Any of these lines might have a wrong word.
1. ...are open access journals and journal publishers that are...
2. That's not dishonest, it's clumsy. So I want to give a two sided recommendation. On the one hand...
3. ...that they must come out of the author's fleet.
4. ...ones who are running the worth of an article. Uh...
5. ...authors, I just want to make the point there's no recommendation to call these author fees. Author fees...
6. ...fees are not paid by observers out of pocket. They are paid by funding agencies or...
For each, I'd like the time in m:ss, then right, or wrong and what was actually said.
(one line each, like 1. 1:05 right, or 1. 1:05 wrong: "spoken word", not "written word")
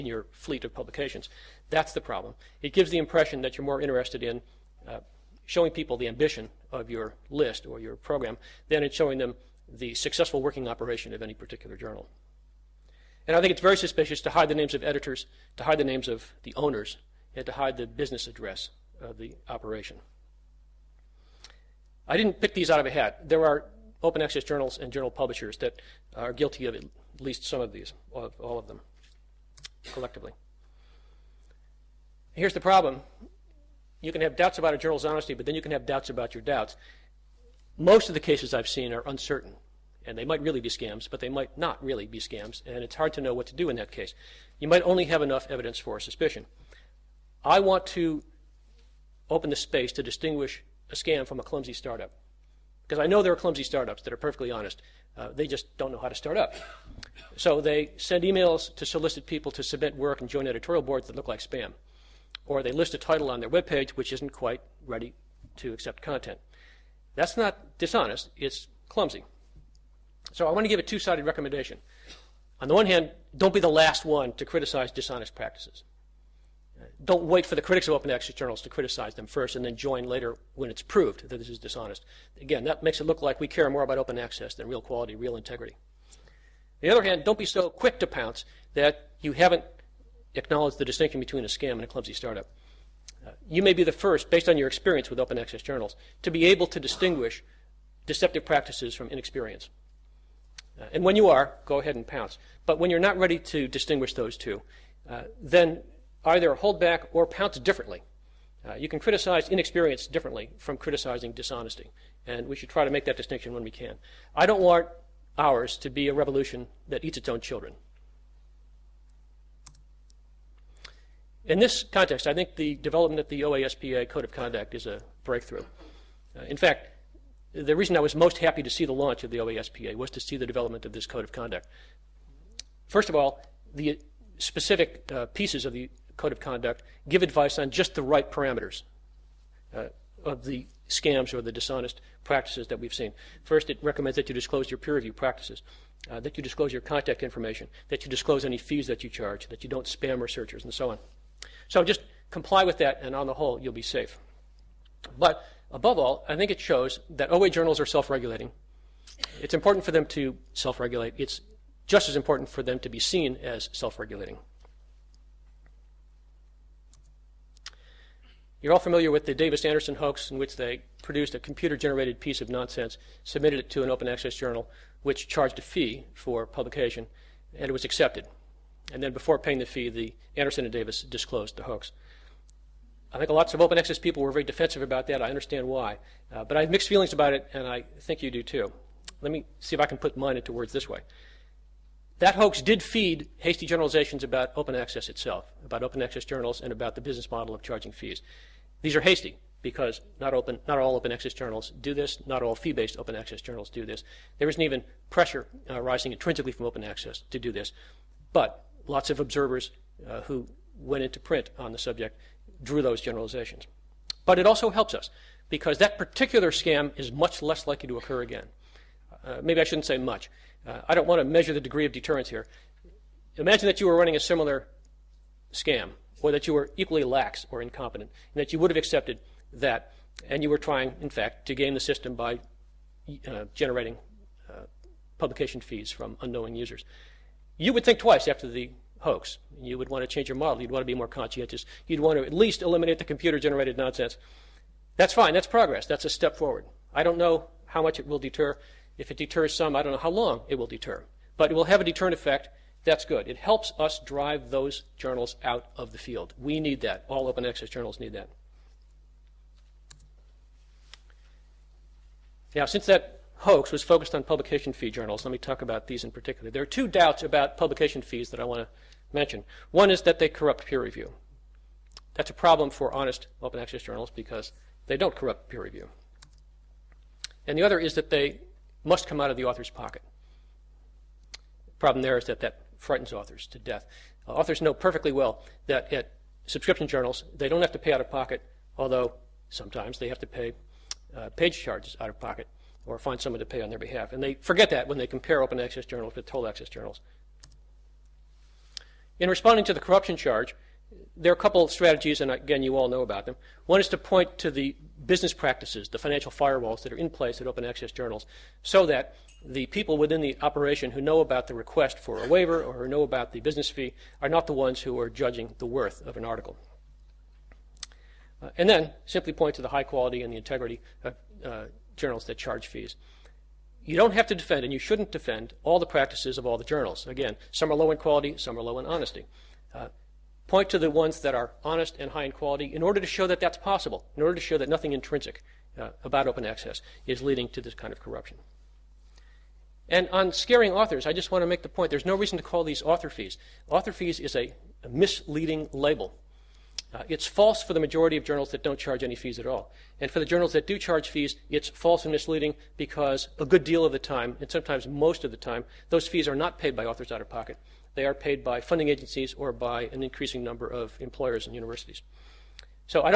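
1. 0:23 right
2. 1:07 right
3. 4:37 wrong: "pocket", not "fleet"
4. 5:14 wrong: "judging", not "running"
5. 5:40 wrong: "reason", not "recommendation"
6. 5:56 wrong: "authors", not "observers".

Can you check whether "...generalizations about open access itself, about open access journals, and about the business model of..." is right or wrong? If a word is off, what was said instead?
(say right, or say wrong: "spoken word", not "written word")
right.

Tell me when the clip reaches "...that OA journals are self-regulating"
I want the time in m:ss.
2:37.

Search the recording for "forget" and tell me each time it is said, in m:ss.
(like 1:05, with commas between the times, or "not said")
4:54.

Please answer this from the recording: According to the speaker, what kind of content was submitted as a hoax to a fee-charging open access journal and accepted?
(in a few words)
computer generated nonsense.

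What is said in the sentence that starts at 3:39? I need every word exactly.
Uh, maybe I shouldn't say much.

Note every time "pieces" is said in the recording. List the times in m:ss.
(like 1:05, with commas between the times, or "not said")
2:15, 2:52.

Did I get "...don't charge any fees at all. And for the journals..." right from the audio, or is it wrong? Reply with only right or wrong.
right.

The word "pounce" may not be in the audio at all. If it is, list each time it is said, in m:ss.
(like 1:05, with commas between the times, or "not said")
1:28, 1:42, 1:47.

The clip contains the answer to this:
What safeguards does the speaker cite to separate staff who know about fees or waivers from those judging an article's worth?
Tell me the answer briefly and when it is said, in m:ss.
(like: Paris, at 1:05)
financial firewalls, at 5:05.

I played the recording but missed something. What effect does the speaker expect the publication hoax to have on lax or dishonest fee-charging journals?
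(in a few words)
deterrent effect.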